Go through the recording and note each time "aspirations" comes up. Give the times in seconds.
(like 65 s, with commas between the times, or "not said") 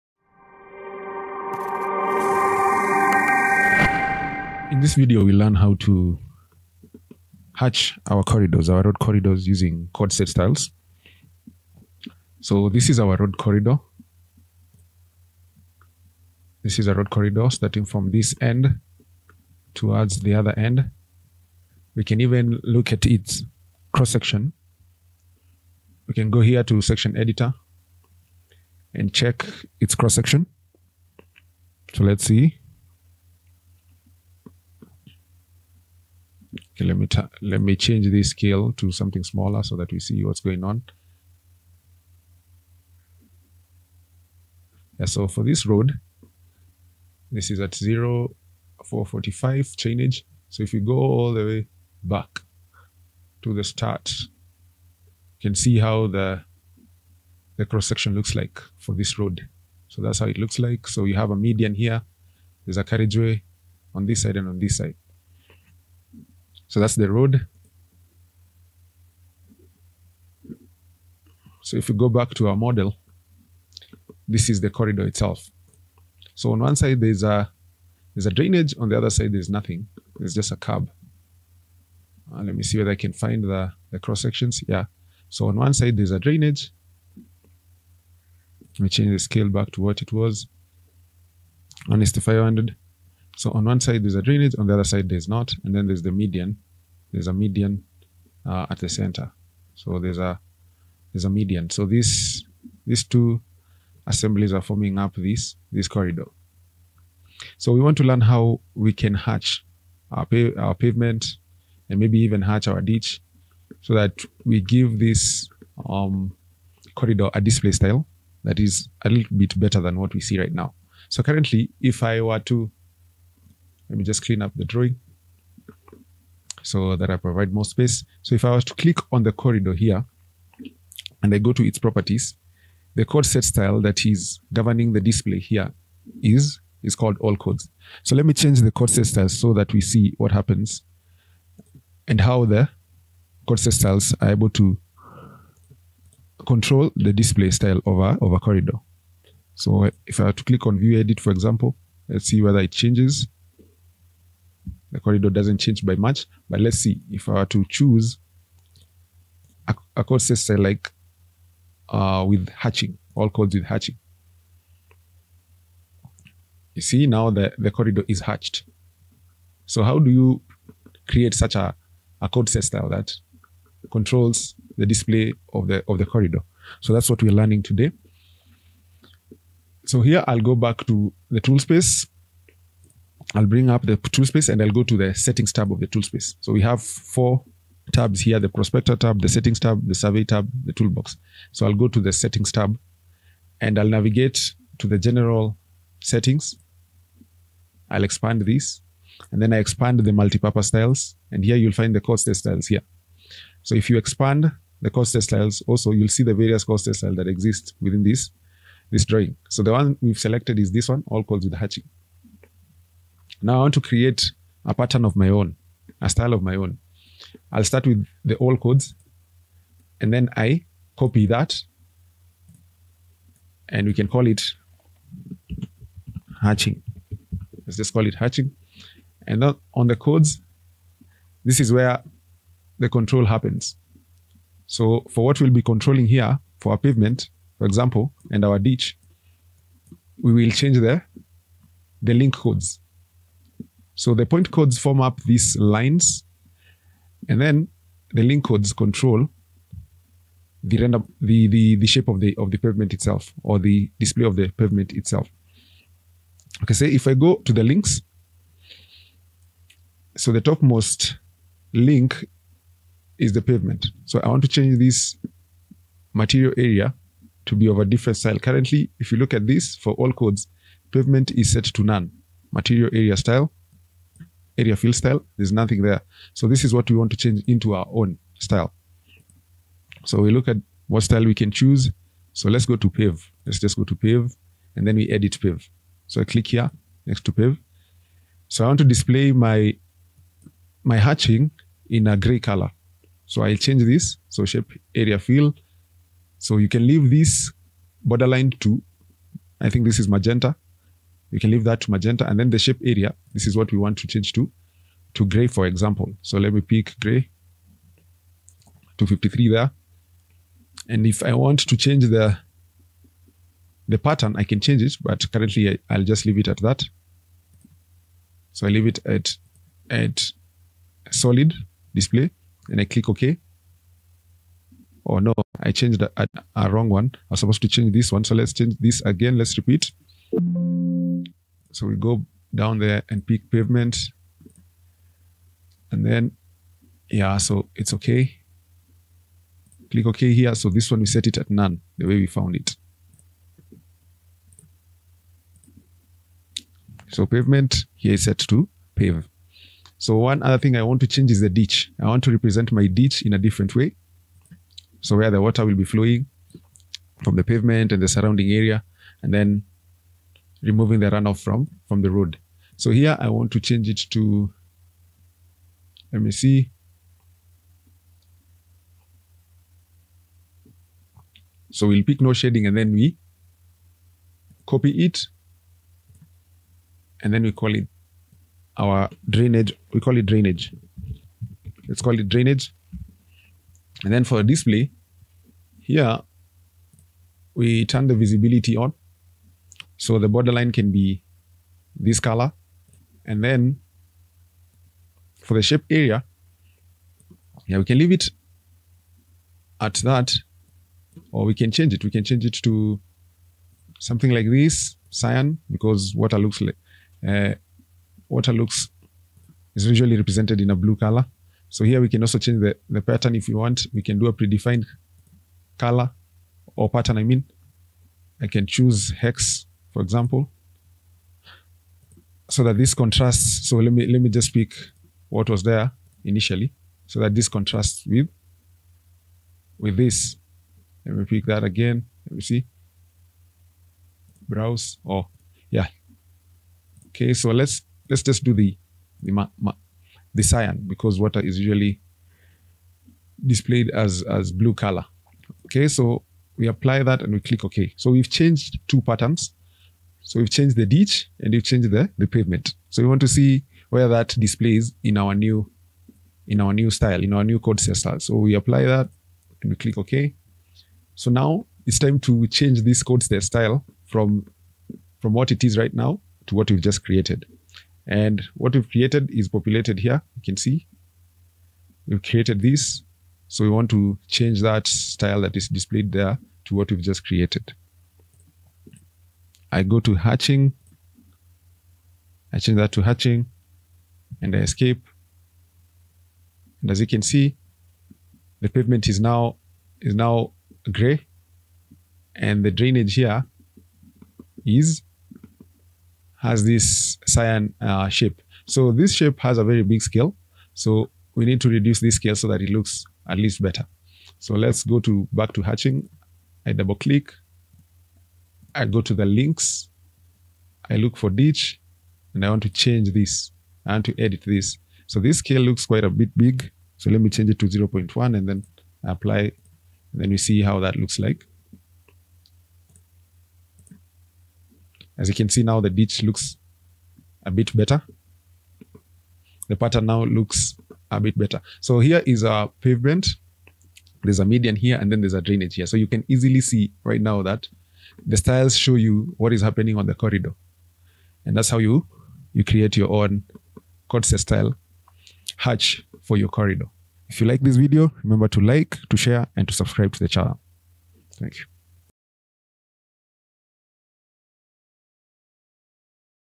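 not said.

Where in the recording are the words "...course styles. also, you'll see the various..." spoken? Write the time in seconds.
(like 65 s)
204 s.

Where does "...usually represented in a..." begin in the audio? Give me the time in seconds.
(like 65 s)
409 s.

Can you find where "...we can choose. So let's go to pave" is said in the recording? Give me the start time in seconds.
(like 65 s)
281 s.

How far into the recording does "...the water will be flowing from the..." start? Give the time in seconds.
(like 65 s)
355 s.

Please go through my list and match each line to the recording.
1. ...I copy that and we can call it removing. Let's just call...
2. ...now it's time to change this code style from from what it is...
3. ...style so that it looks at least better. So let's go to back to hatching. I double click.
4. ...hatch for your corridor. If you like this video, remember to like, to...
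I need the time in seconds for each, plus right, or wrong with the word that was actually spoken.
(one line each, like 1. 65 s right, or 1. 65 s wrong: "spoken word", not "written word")
1. 220 s wrong: "hatching", not "removing"
2. 461 s right
3. 502 s wrong: "scale", not "style"
4. 545 s right.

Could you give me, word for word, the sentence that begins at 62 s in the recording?
There's a carriageway on this side and on this side.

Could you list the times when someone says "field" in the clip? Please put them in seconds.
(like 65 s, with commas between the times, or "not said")
274 s.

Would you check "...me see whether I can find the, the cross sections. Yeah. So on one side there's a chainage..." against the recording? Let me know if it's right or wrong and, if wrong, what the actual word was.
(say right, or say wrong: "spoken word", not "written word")
wrong: "drainage", not "chainage".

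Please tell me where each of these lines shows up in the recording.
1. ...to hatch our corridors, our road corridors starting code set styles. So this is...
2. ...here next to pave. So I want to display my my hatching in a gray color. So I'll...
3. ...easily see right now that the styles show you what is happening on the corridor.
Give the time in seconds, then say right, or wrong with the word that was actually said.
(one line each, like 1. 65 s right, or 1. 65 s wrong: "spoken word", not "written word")
1. 5 s wrong: "using", not "starting"
2. 286 s right
3. 536 s right.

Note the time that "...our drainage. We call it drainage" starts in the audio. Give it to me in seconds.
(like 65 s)
378 s.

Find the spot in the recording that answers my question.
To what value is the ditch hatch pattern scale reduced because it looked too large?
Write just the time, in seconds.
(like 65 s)
517 s.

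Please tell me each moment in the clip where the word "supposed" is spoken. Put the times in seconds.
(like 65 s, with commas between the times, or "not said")
327 s.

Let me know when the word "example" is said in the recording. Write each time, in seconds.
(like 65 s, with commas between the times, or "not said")
151 s, 237 s, 305 s, 420 s.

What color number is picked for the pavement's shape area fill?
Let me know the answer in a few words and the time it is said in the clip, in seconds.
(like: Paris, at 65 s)
253, at 308 s.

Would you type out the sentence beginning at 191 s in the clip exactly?
So I'll go to the settings tab and I'll navigate to the general settings.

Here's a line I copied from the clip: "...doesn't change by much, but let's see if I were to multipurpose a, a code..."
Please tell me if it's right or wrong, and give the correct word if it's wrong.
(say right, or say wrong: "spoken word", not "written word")
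wrong: "choose", not "multipurpose".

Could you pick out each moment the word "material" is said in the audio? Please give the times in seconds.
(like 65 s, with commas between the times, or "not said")
266 s, 272 s.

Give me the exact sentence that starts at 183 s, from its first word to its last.
I'll bring up the tool space and I'll go to the settings tab of the tool space.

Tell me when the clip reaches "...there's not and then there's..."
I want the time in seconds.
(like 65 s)
95 s.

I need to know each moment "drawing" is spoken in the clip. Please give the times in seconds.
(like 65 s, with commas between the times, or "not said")
124 s, 209 s.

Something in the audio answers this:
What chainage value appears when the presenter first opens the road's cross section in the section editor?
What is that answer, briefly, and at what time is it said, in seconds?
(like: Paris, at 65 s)
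0+445, at 47 s.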